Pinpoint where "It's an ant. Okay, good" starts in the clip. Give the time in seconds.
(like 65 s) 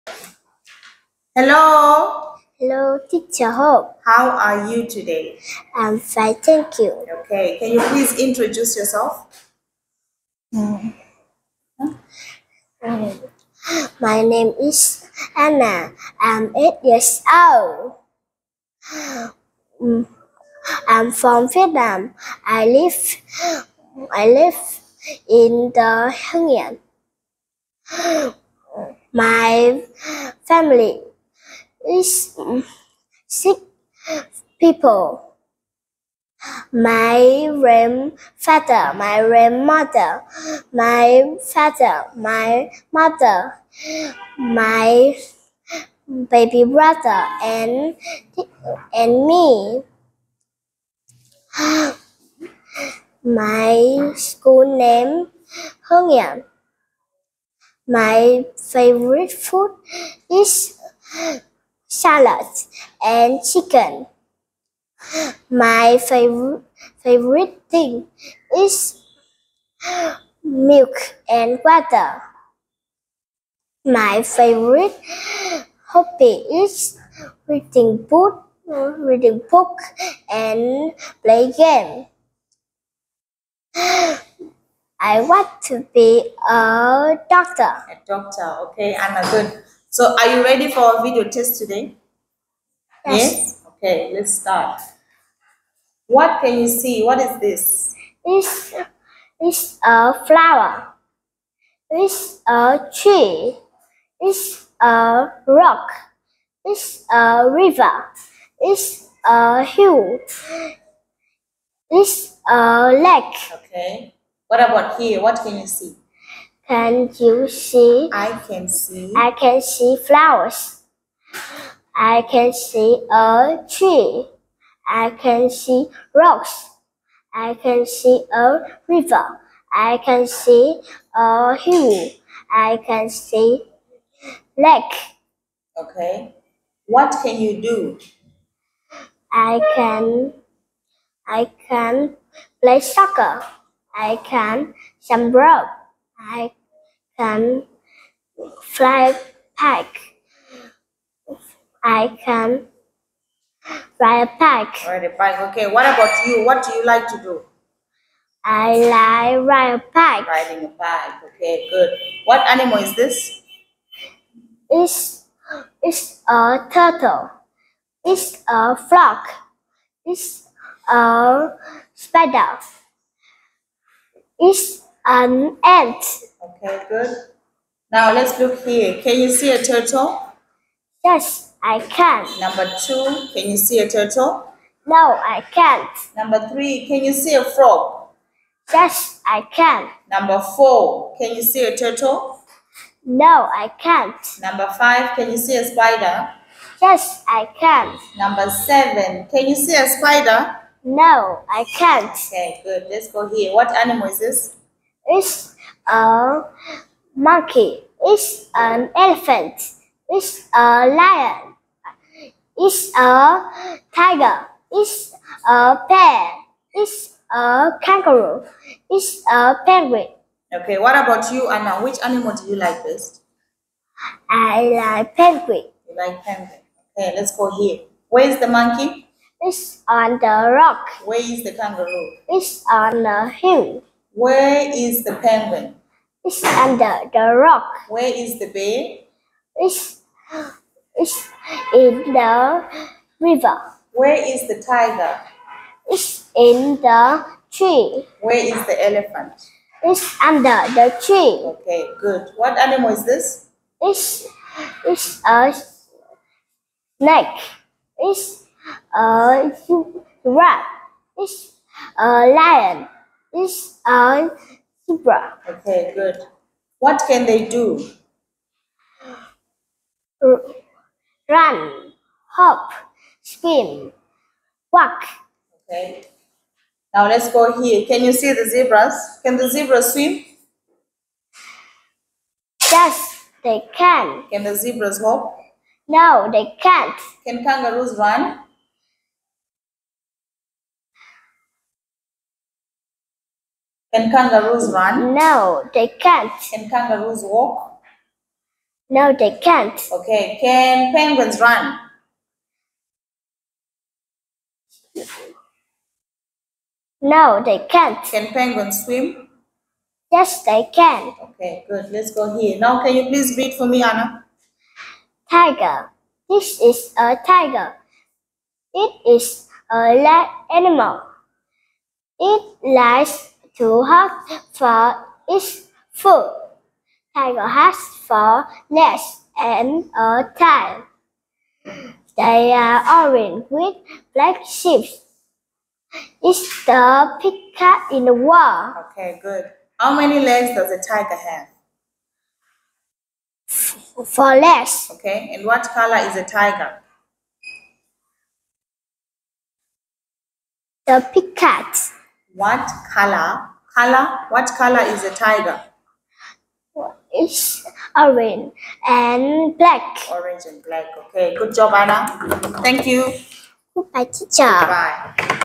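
174 s.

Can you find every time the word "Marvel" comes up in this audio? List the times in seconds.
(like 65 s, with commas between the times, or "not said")
not said.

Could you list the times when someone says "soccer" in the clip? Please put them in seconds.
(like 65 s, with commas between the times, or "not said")
142 s.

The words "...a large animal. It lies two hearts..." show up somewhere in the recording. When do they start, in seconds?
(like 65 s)
319 s.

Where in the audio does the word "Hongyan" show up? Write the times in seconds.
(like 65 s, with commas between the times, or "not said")
55 s.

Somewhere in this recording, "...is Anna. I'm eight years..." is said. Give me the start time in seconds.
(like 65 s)
14 s.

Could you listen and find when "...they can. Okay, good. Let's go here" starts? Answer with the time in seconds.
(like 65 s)
310 s.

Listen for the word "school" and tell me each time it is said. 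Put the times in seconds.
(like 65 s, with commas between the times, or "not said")
54 s.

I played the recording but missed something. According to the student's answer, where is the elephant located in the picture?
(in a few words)
under the tree.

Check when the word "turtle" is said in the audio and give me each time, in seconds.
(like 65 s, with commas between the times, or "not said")
166 s, 179 s, 183 s, 191 s.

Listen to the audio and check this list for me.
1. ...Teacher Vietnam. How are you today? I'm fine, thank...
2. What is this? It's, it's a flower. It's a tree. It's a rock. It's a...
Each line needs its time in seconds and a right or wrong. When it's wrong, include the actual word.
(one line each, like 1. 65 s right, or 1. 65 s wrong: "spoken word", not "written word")
1. 3 s wrong: "Hope", not "Vietnam"
2. 97 s right.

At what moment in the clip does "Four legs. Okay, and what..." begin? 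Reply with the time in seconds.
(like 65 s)
344 s.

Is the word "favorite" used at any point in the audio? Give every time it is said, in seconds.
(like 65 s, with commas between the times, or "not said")
58 s, 67 s, 74 s.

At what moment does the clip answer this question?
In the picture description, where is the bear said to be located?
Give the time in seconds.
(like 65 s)
241 s.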